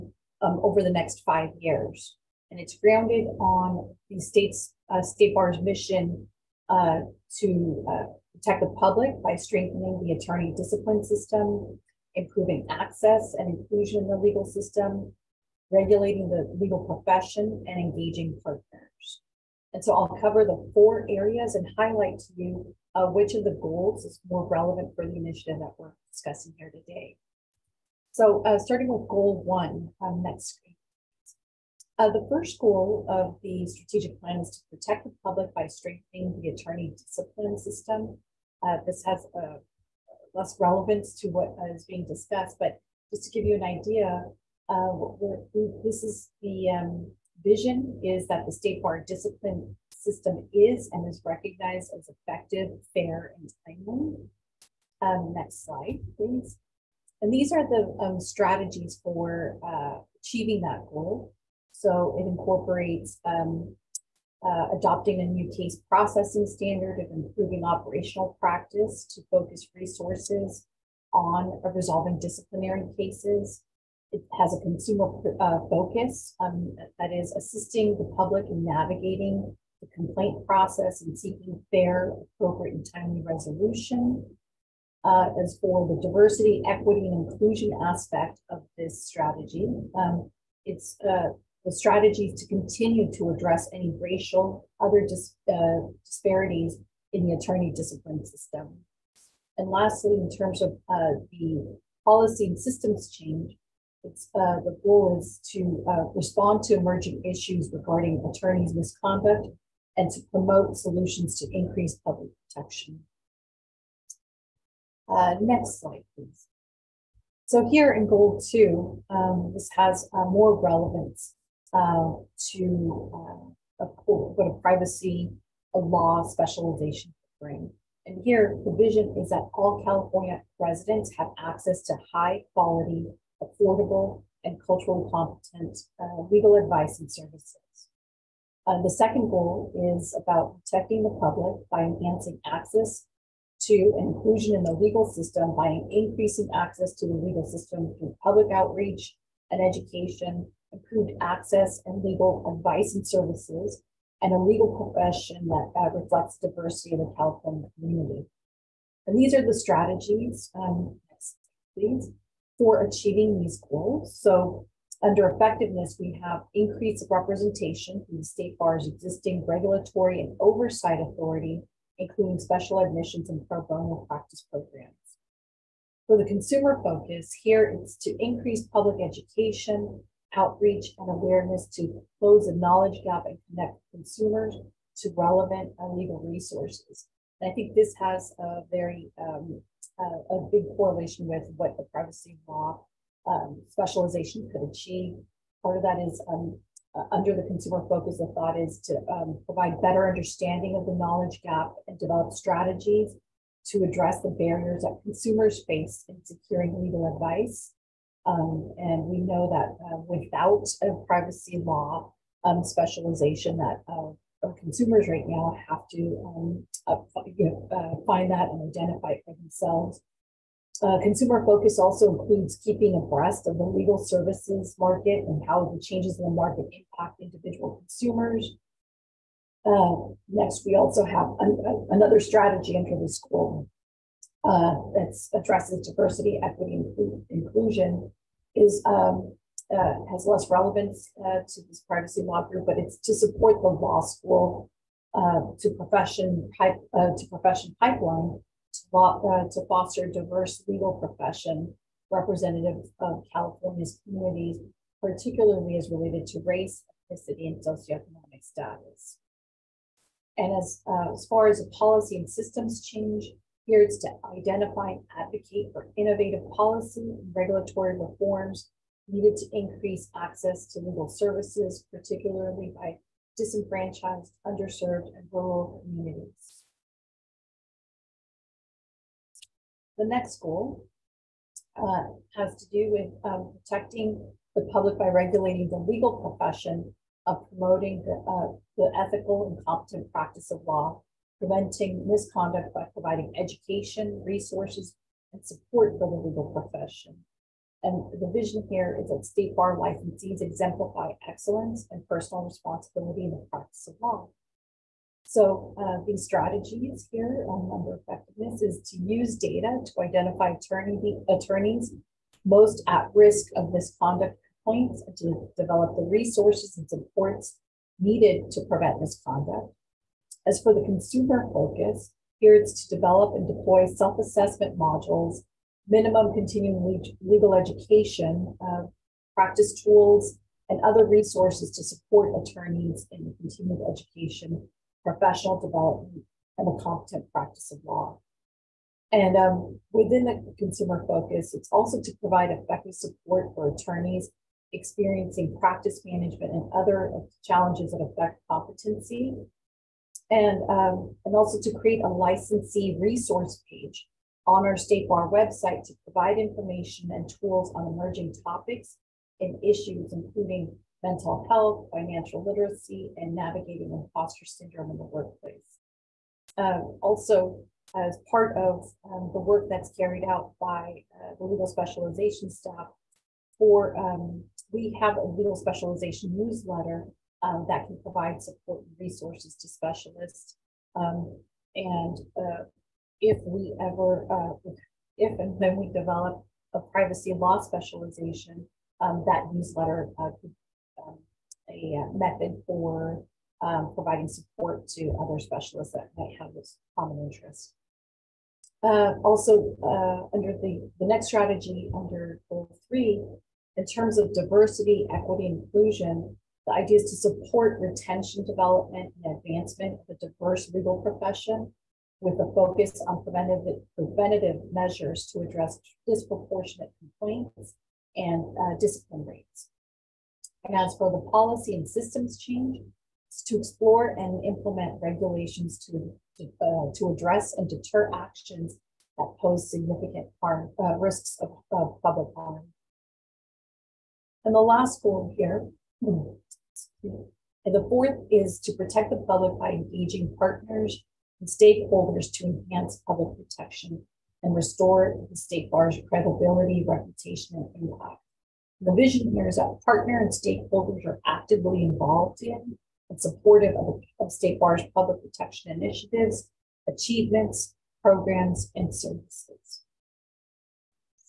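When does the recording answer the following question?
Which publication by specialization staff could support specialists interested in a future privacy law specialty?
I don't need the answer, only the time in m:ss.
6:15.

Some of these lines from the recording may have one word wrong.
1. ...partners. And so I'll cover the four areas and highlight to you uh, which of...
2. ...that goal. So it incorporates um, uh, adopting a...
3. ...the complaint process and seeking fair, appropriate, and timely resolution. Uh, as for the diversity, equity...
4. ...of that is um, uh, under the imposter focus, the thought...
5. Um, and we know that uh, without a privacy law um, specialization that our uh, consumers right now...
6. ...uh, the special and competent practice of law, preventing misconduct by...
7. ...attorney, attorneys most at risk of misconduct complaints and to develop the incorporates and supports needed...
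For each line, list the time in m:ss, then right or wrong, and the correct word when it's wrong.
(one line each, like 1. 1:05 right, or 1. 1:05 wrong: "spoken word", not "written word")
1. 0:18 right
2. 1:00 right
3. 1:19 right
4. 3:15 wrong: "consumer", not "imposter"
5. 3:28 right
6. 4:48 wrong: "ethical", not "special"
7. 5:10 wrong: "resources", not "incorporates".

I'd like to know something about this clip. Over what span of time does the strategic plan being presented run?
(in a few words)
5 years.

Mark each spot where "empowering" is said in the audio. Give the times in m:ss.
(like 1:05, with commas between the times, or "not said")
not said.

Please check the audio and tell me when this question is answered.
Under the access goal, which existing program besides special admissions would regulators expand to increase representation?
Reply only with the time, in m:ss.
2:53.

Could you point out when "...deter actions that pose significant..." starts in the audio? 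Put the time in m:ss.
7:07.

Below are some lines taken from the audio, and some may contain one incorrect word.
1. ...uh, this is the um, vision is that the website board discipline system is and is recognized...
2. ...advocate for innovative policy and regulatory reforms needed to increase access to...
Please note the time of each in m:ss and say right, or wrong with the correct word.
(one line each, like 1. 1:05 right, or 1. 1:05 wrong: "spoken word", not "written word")
1. 0:44 wrong: "state", not "website"
2. 4:25 right.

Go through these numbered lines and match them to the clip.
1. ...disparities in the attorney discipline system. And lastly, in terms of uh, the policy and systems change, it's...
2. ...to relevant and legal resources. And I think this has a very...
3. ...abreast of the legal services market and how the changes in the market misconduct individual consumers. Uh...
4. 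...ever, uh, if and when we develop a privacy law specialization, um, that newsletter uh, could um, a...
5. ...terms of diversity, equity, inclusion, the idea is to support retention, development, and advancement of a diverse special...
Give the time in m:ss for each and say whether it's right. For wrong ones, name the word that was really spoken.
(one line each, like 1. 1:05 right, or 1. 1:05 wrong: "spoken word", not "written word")
1. 1:36 right
2. 3:04 right
3. 3:42 wrong: "impact", not "misconduct"
4. 6:23 right
5. 6:43 wrong: "legal", not "special".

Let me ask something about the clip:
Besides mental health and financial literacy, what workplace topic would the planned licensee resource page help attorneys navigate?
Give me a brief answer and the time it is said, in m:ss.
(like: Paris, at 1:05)
imposter syndrome, at 6:03.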